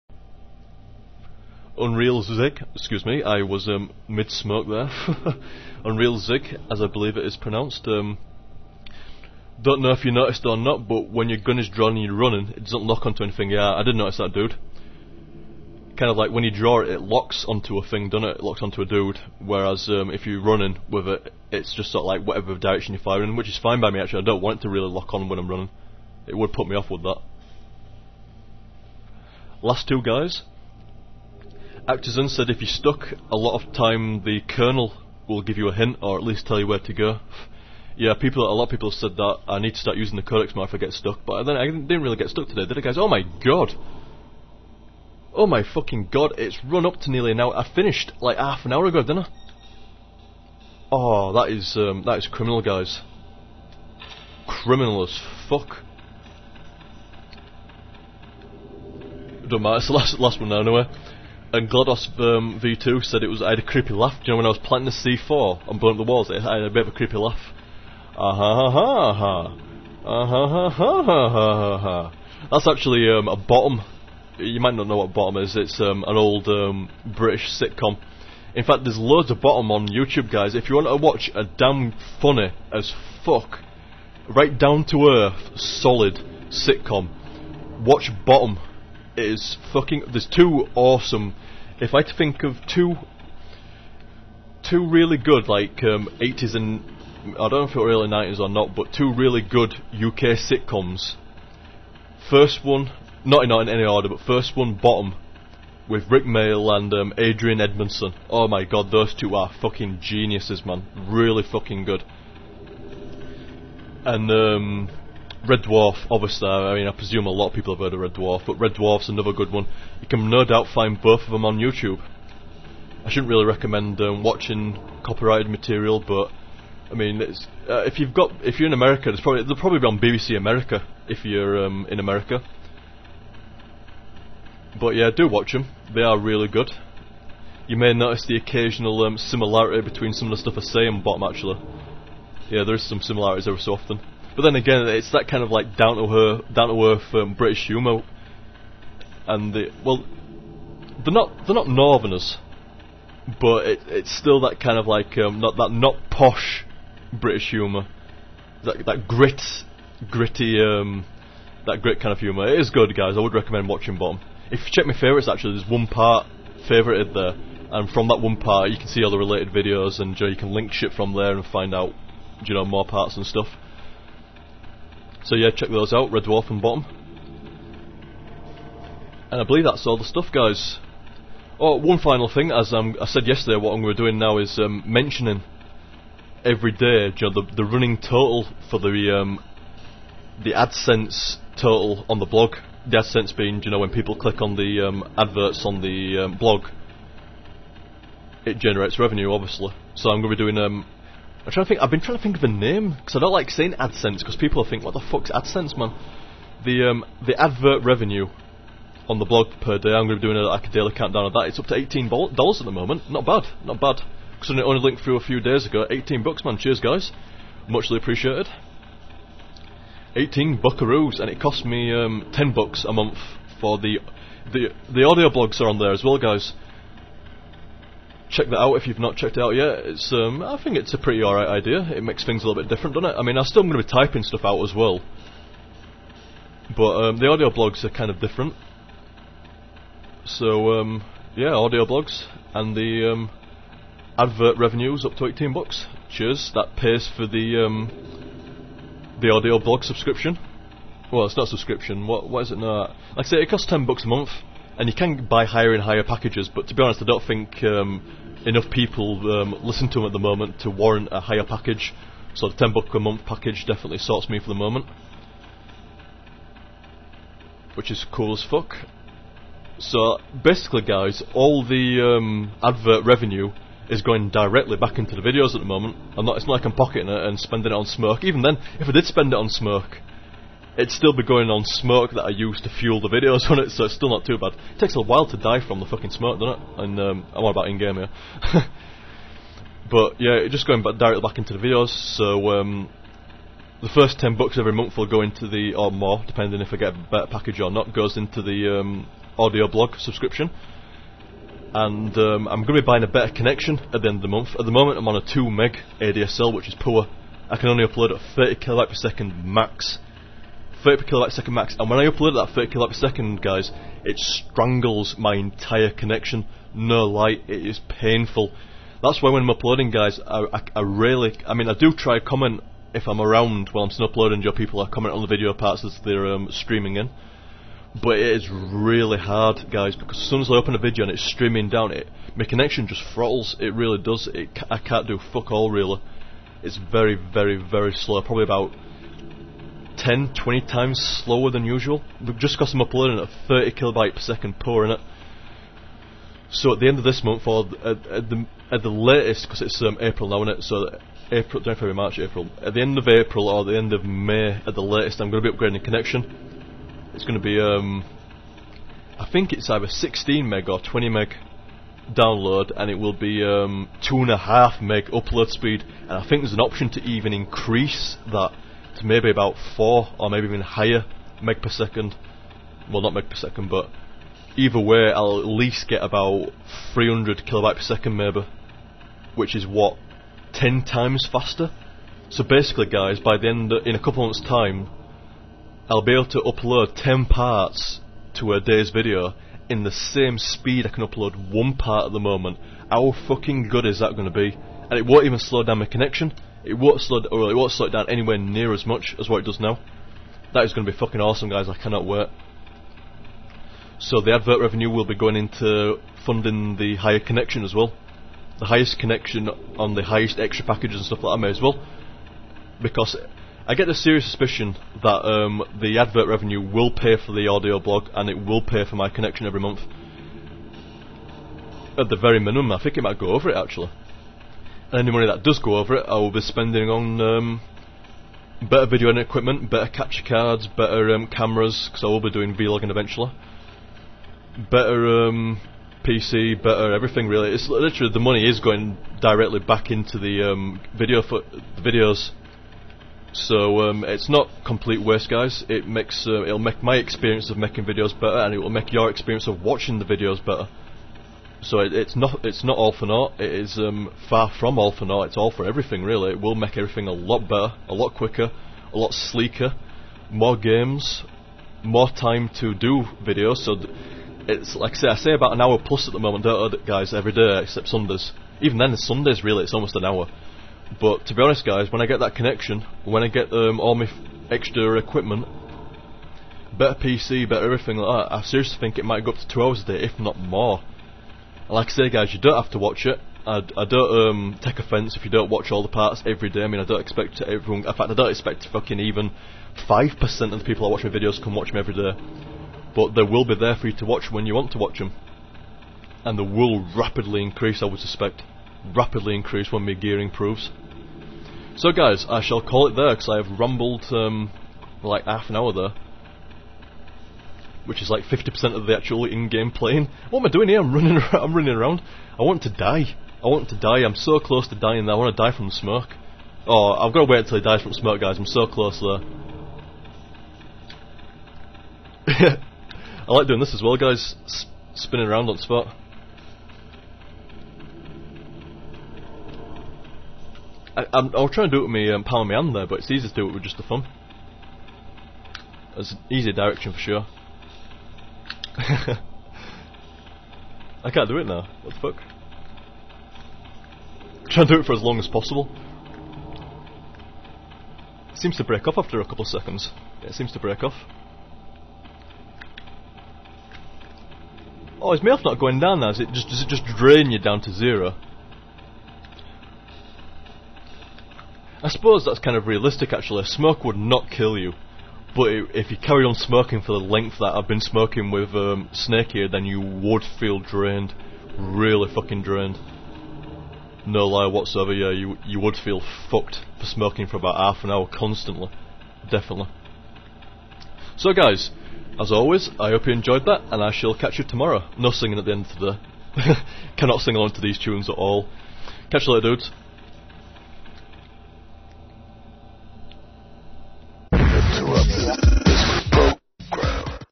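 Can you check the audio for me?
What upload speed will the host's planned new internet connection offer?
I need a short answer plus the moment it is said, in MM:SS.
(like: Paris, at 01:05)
2.5 meg, at 06:04.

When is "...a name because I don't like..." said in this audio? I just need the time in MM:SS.
03:22.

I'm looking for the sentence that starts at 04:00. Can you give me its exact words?
So, um, yeah, audio blogs and the um, advert revenues up to 18 bucks.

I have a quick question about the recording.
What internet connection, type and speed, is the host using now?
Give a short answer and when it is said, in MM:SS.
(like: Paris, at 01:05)
2 meg ADSL, at 05:05.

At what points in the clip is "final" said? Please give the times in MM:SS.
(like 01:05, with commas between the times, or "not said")
03:01.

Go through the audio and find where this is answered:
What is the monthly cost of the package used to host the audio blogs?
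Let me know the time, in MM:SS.
03:42.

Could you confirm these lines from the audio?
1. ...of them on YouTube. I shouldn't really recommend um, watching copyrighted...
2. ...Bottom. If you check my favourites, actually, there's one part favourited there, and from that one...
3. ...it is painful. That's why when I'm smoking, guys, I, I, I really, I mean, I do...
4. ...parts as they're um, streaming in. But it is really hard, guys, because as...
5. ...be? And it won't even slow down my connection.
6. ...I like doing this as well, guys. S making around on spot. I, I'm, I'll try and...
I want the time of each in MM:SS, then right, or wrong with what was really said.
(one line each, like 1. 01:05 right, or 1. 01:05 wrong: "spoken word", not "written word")
1. 02:01 right
2. 02:43 right
3. 05:17 wrong: "uploading", not "smoking"
4. 05:25 right
5. 06:34 right
6. 08:42 wrong: "spinning", not "making".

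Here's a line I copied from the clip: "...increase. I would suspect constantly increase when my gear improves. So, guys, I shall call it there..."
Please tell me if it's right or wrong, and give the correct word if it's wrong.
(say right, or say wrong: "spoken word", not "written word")
wrong: "rapidly", not "constantly".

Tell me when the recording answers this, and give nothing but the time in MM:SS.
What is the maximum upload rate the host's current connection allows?
05:08.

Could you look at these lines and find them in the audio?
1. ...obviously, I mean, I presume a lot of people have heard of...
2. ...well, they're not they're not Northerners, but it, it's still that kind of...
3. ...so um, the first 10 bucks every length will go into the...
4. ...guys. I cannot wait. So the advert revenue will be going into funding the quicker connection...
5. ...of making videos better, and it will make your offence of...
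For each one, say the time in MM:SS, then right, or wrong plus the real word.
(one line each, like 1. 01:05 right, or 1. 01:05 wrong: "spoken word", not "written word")
1. 01:56 right
2. 02:29 right
3. 04:52 wrong: "month", not "length"
4. 06:41 wrong: "higher", not "quicker"
5. 07:27 wrong: "experience", not "offence".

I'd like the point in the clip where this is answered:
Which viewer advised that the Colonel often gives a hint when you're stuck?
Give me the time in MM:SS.
00:31.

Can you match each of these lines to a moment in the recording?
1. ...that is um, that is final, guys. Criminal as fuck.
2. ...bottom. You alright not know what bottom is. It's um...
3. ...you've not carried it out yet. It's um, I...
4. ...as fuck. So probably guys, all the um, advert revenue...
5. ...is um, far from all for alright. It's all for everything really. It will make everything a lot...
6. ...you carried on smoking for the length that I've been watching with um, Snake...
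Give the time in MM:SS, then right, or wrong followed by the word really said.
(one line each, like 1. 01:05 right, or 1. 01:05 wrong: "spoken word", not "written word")
1. 00:51 wrong: "criminal", not "final"
2. 01:13 wrong: "might", not "alright"
3. 03:48 wrong: "checked", not "carried"
4. 04:28 wrong: "basically", not "probably"
5. 07:33 wrong: "naught", not "alright"
6. 09:25 wrong: "smoking", not "watching".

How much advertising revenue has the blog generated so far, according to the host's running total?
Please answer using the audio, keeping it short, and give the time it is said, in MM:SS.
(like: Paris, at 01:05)
$18, at 03:31.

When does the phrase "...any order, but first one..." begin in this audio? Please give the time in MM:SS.
01:43.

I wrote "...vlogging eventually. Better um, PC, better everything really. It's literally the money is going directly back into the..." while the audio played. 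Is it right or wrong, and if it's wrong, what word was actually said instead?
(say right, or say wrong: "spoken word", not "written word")
right.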